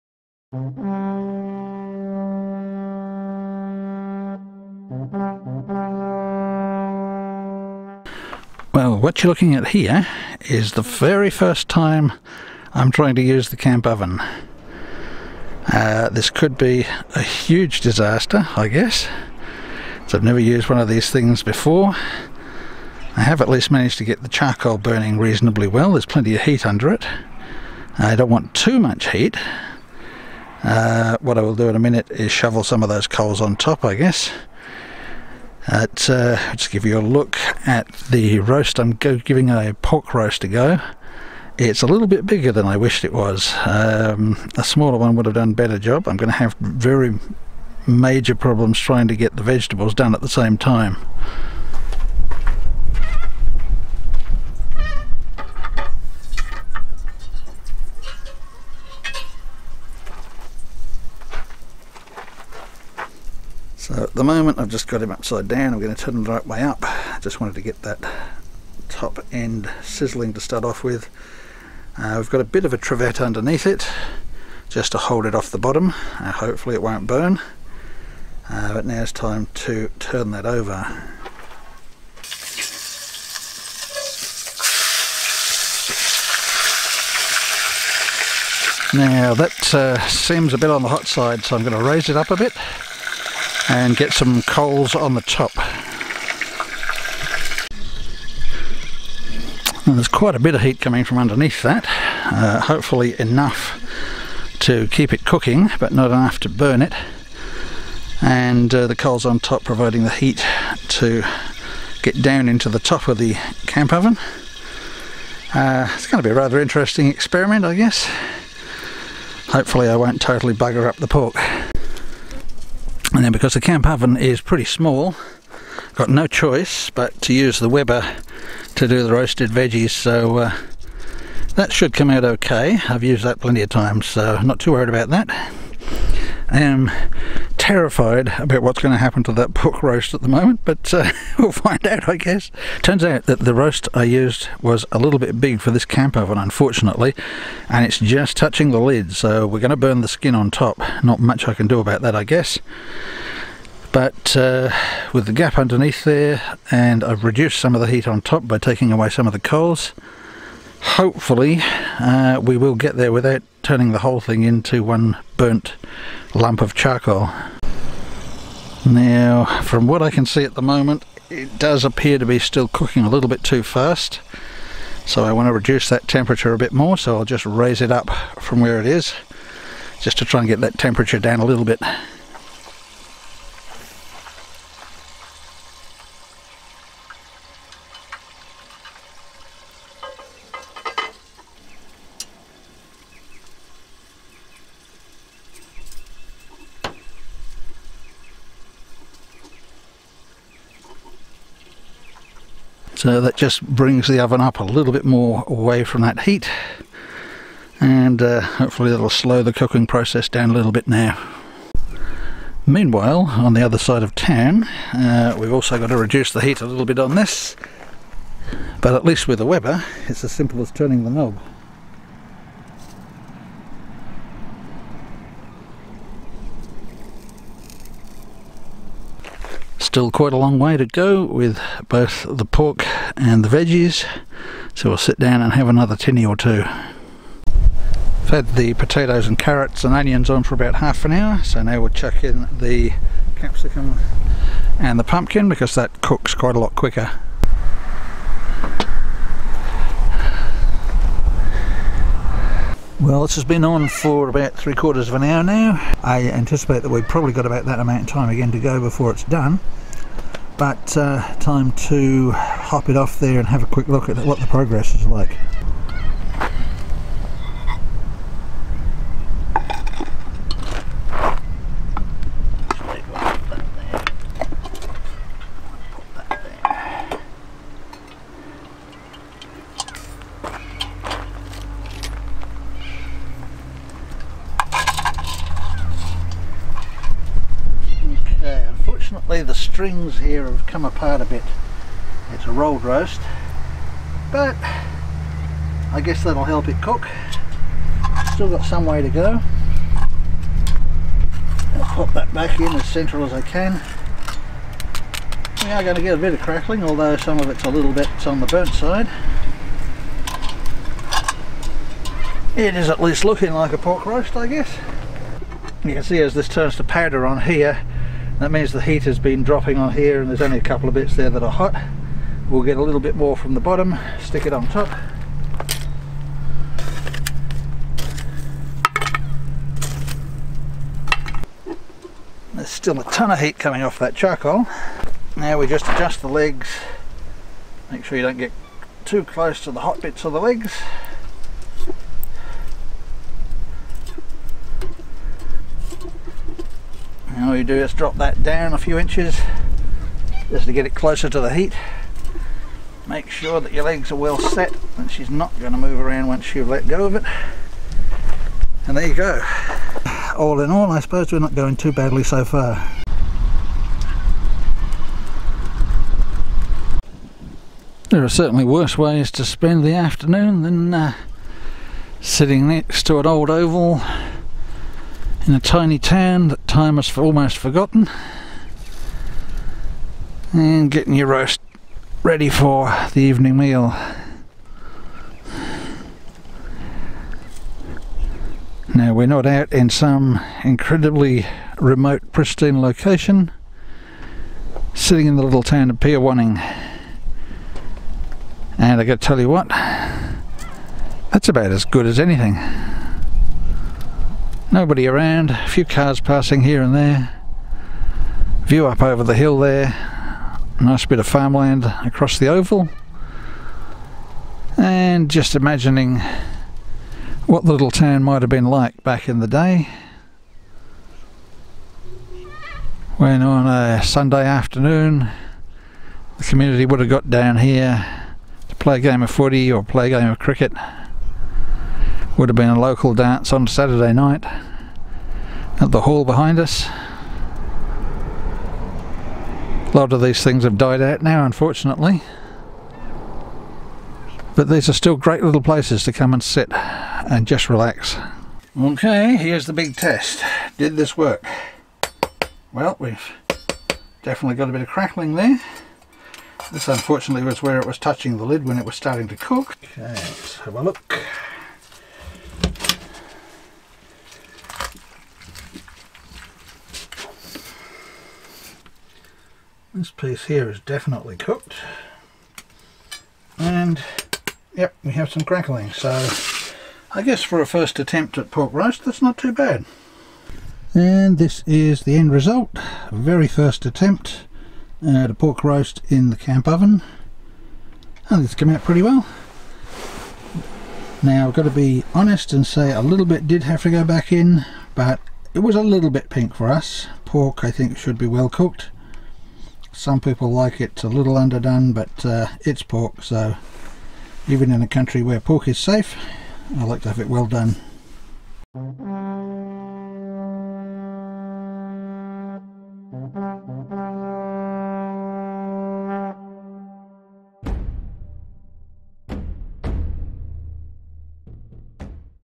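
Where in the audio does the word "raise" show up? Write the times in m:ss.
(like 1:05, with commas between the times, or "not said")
1:31, 2:57.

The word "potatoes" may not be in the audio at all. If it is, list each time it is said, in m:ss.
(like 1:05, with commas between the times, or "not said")
3:58.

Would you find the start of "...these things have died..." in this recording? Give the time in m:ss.
7:20.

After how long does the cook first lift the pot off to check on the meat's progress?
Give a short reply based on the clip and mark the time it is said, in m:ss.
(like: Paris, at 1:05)
Three quarters of an hour, at 4:14.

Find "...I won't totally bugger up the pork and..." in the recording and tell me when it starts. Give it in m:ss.
1:59.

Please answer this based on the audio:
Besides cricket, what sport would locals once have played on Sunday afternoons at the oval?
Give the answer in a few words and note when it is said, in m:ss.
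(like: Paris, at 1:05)
Footy, at 7:09.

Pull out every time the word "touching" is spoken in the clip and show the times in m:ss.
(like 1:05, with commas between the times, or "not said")
2:28, 7:37.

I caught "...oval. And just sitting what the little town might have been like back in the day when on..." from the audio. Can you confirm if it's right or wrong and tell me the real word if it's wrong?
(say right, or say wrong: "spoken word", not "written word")
wrong: "imagining", not "sitting".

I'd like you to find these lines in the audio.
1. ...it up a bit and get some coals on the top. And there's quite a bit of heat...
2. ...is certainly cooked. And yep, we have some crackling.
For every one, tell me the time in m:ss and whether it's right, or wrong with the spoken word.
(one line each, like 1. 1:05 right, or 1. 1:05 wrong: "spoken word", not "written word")
1. 1:32 right
2. 7:50 wrong: "definitely", not "certainly".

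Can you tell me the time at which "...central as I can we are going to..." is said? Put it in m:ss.
5:02.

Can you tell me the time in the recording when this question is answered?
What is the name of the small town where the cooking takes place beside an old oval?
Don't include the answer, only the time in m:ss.
6:35.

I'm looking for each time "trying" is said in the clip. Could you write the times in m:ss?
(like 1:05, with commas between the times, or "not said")
0:12, 0:48.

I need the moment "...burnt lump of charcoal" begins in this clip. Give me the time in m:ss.
2:45.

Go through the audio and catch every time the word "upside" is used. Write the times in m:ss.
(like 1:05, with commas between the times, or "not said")
1:05.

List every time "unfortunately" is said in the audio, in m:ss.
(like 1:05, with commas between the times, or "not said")
2:26, 7:21, 7:36.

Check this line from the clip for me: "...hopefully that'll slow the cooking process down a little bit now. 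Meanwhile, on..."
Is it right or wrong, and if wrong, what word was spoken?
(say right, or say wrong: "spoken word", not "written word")
right.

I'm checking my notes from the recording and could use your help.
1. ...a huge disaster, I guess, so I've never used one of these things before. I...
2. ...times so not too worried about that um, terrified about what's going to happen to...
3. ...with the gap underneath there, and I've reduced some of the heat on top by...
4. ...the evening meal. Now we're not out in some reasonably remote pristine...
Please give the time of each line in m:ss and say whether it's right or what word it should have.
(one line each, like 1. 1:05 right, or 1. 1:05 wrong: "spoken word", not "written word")
1. 0:17 right
2. 2:13 right
3. 2:35 right
4. 6:23 wrong: "incredibly", not "reasonably".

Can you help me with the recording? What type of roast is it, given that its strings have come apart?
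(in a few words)
Rolled roast.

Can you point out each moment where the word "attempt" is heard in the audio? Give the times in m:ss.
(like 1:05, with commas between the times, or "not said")
7:57, 8:03.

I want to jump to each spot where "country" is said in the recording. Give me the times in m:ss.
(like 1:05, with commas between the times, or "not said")
8:24.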